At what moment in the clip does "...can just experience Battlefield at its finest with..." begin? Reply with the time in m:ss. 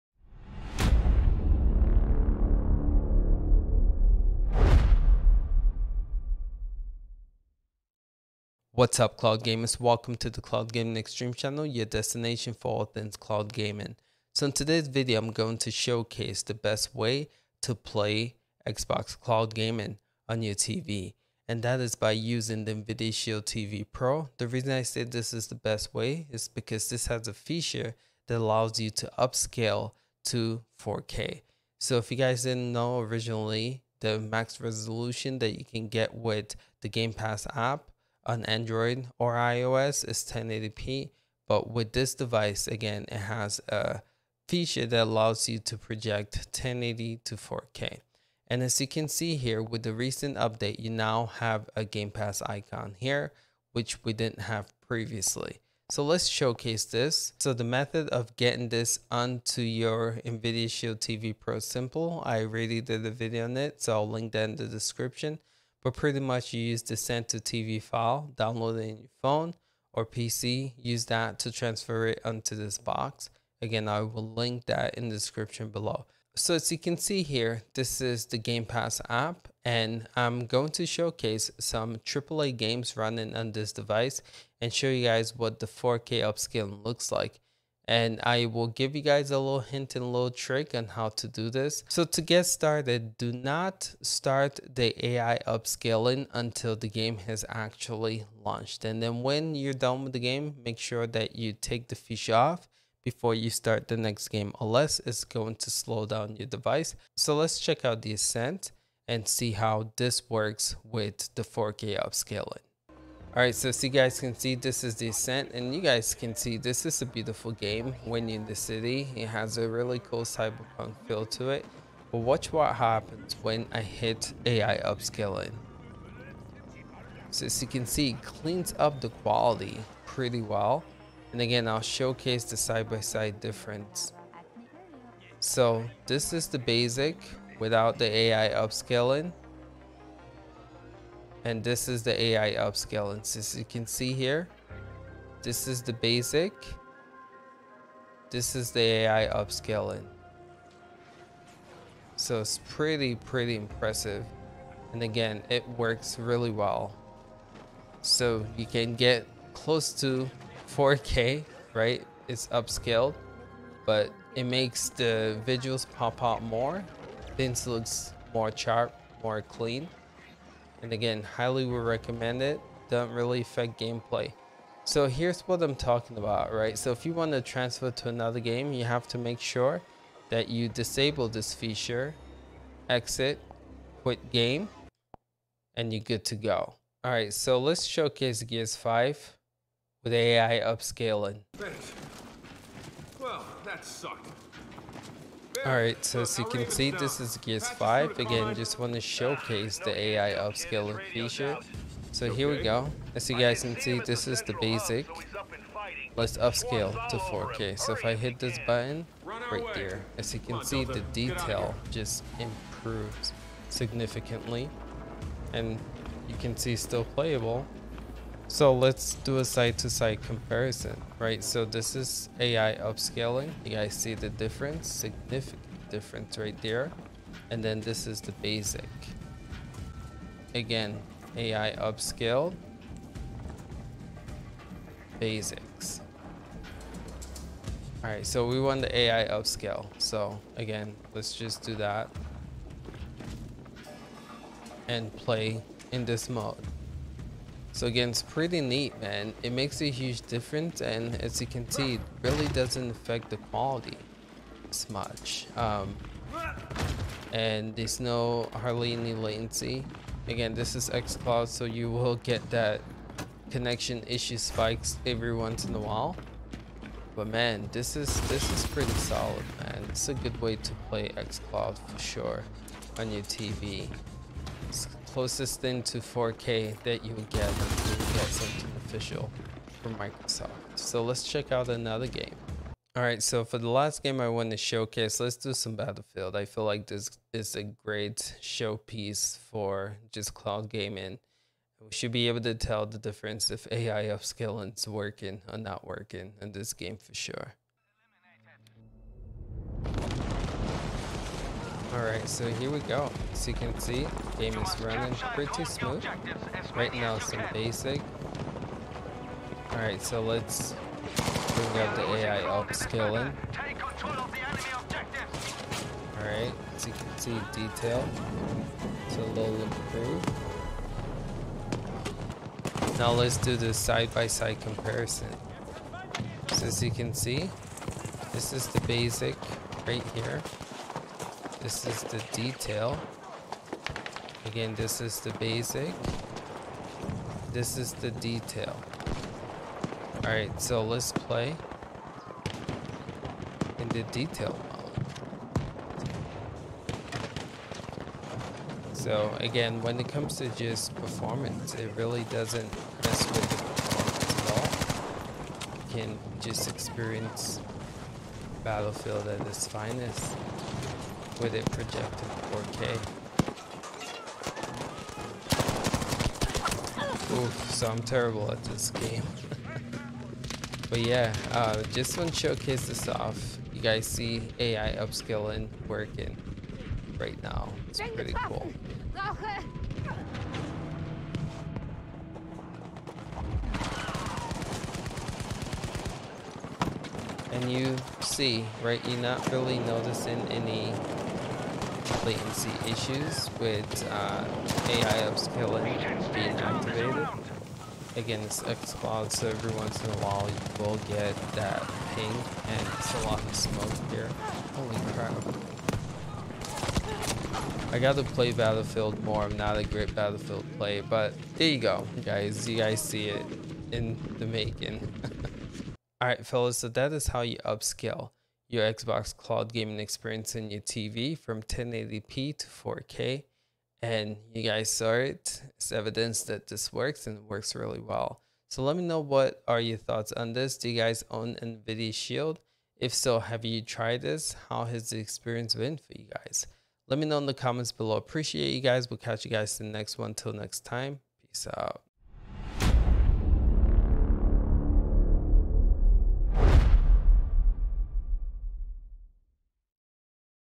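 5:56.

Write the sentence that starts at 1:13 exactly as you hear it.
Again, I will link that in the description below.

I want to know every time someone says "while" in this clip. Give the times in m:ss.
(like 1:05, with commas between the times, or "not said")
4:25, 6:40.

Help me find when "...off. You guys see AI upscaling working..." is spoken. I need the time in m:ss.
6:13.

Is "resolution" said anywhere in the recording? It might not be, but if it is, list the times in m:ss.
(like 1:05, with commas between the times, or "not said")
0:34.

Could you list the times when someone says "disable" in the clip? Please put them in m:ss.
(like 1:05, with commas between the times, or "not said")
3:00.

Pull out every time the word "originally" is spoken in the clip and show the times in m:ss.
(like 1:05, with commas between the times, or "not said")
0:33.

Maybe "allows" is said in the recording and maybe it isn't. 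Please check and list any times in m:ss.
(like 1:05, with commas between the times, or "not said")
0:28, 0:45.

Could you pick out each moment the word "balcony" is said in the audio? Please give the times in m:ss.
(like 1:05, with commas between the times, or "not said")
not said.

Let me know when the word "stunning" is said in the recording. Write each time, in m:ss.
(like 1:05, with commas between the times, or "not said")
not said.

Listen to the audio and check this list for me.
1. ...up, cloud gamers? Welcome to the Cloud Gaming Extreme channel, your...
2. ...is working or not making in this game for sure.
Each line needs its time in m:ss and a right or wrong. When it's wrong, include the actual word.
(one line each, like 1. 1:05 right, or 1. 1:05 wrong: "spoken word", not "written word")
1. 0:08 right
2. 4:54 wrong: "working", not "making".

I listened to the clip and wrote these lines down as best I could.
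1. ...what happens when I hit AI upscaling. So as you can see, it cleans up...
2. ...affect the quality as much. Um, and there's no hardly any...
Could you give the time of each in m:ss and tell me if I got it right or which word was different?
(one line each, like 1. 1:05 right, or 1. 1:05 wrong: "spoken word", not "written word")
1. 2:02 right
2. 4:12 right.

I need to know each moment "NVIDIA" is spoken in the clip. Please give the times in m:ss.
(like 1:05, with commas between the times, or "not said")
0:22, 1:00, 7:11.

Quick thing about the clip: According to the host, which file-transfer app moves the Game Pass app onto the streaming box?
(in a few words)
Send to TV.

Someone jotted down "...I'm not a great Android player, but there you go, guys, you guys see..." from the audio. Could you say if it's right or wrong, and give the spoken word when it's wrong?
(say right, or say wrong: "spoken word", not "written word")
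wrong: "Battlefield", not "Android".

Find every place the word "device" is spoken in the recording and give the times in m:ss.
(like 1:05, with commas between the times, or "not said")
0:42, 1:23, 1:46.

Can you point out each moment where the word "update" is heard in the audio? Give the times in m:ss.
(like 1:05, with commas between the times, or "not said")
0:50.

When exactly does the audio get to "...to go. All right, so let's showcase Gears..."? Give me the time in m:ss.
3:06.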